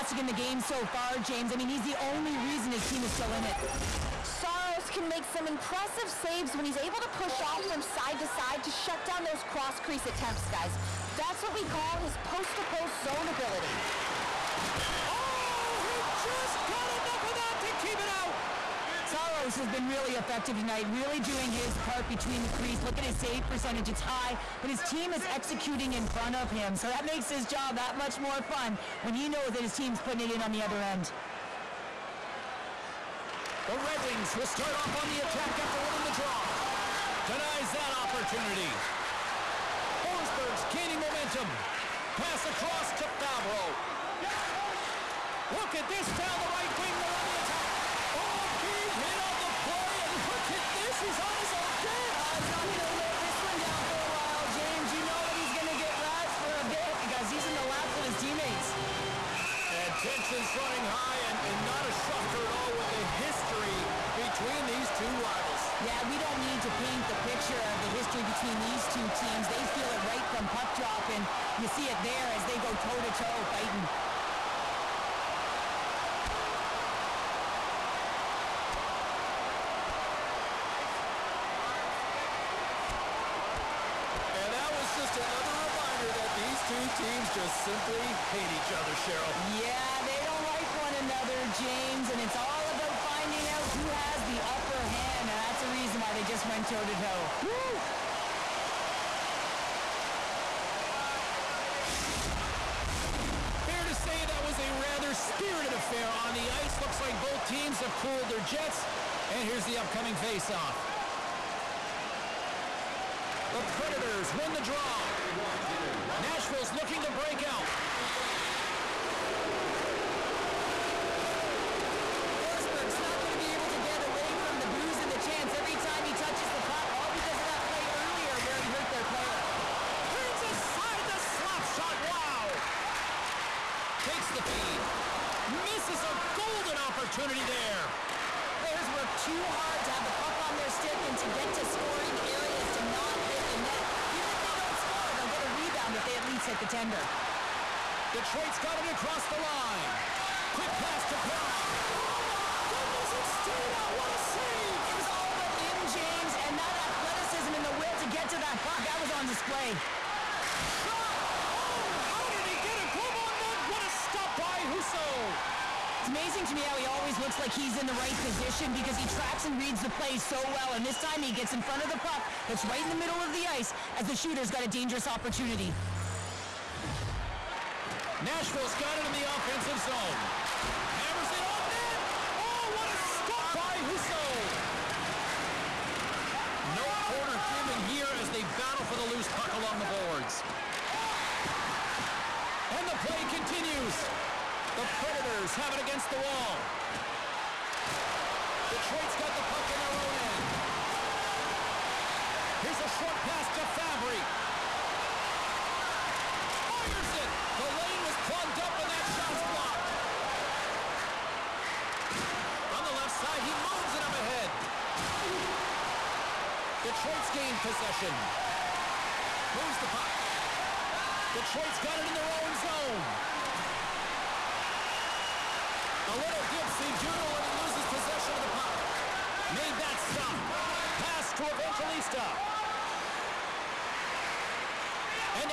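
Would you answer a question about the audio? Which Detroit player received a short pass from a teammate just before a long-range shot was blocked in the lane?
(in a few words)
Fabbri.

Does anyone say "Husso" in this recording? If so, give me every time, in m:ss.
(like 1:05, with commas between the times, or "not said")
2:44, 3:03.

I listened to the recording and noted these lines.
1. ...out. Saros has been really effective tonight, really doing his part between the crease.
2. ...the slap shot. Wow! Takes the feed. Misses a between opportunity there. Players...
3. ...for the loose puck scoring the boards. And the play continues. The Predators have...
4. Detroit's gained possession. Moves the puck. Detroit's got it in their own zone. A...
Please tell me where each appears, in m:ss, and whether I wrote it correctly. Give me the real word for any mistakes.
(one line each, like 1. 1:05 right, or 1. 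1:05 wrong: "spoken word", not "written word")
1. 0:18 right
2. 2:11 wrong: "golden", not "between"
3. 3:08 wrong: "along", not "scoring"
4. 3:36 right.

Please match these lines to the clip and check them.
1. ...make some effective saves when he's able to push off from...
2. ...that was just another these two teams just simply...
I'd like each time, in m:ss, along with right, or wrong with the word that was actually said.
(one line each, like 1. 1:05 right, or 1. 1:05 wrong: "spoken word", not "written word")
1. 0:05 wrong: "impressive", not "effective"
2. 1:24 right.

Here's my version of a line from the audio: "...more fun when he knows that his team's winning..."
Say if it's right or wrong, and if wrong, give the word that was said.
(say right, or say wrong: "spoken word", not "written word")
wrong: "putting", not "winning".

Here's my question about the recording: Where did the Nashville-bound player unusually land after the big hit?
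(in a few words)
His own bench.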